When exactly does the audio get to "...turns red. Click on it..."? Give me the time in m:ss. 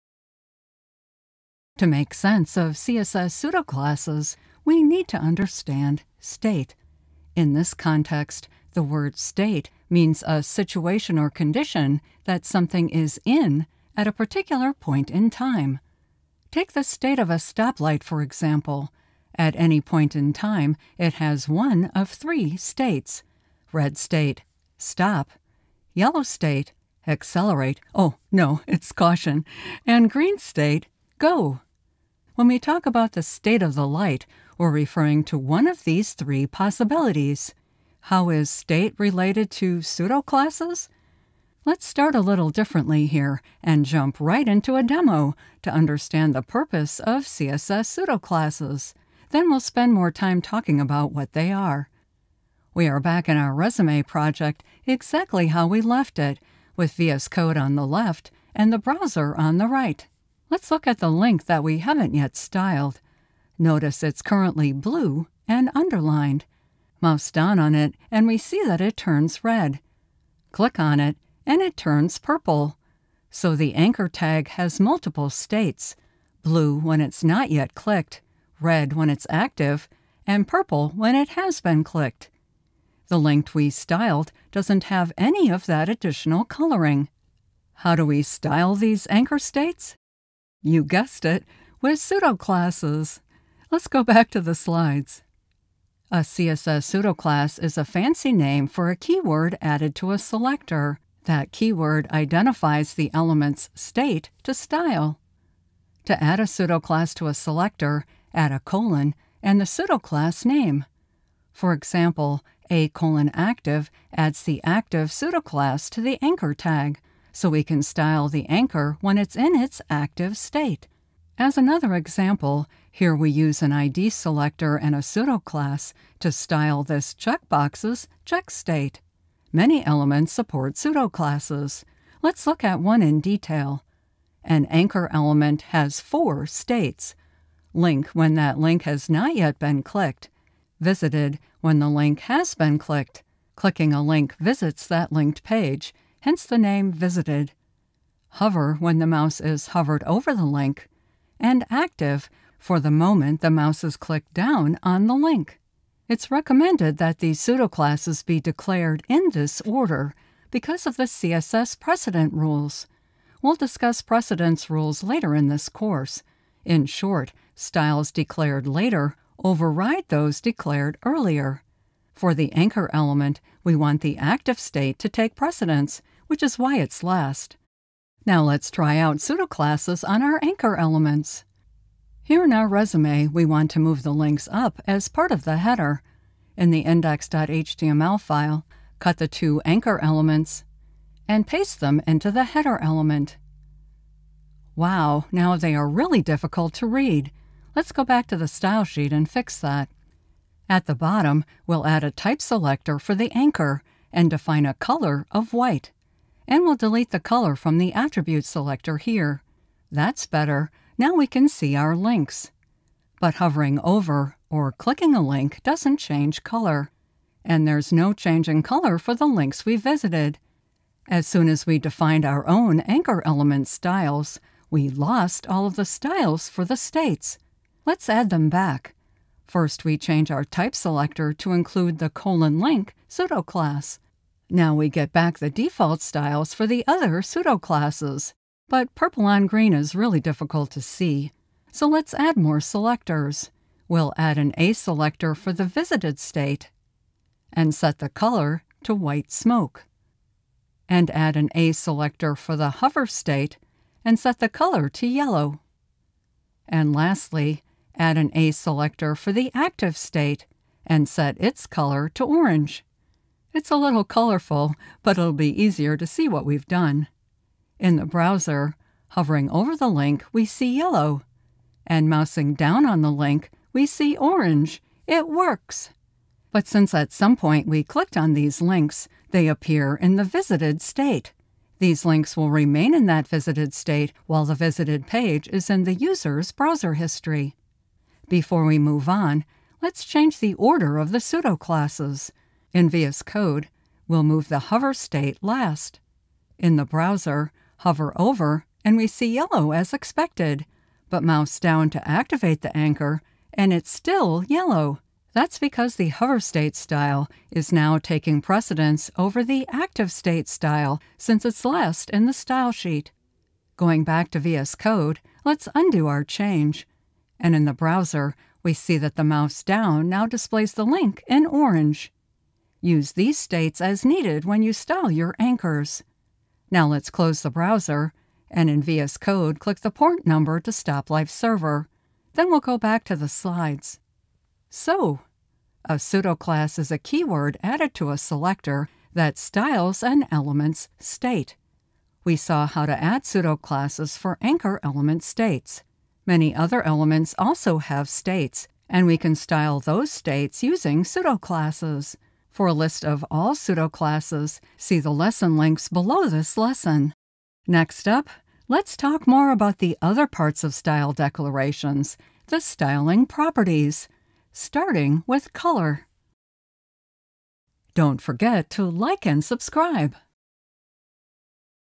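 1:08.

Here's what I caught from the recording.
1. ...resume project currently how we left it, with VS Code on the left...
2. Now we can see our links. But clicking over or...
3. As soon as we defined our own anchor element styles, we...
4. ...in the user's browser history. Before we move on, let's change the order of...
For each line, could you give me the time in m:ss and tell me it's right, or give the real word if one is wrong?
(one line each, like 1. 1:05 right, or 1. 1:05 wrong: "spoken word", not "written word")
1. 0:53 wrong: "exactly", not "currently"
2. 3:30 wrong: "hovering", not "clicking"
3. 3:41 right
4. 4:45 right.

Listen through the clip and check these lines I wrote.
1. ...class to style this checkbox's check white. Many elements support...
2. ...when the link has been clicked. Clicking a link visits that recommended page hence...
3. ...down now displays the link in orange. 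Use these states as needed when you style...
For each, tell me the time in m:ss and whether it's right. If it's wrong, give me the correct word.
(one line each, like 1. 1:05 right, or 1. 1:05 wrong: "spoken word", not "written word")
1. 2:05 wrong: "state", not "white"
2. 2:21 wrong: "linked", not "recommended"
3. 5:19 right.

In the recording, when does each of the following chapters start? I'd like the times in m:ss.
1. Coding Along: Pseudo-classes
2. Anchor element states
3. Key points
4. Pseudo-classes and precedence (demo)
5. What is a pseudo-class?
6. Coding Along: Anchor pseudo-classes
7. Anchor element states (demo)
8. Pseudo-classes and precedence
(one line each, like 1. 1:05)
1. 0:41
2. 2:14
3. 5:34
4. 4:47
5. 1:35
6. 2:57
7. 1:00
8. 2:35.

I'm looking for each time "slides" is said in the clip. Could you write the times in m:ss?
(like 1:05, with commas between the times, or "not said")
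1:34, 5:33.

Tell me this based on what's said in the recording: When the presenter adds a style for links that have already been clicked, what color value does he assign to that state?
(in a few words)
white smoke.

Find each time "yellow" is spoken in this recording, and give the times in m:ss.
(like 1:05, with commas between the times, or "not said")
0:25, 4:15, 4:30, 4:59, 5:04.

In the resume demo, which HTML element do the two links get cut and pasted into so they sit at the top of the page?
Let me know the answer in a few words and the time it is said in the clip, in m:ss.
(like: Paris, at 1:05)
header element, at 3:12.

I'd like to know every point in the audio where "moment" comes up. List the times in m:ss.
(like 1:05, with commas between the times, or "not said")
2:32.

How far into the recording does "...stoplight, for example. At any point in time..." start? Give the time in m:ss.
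0:17.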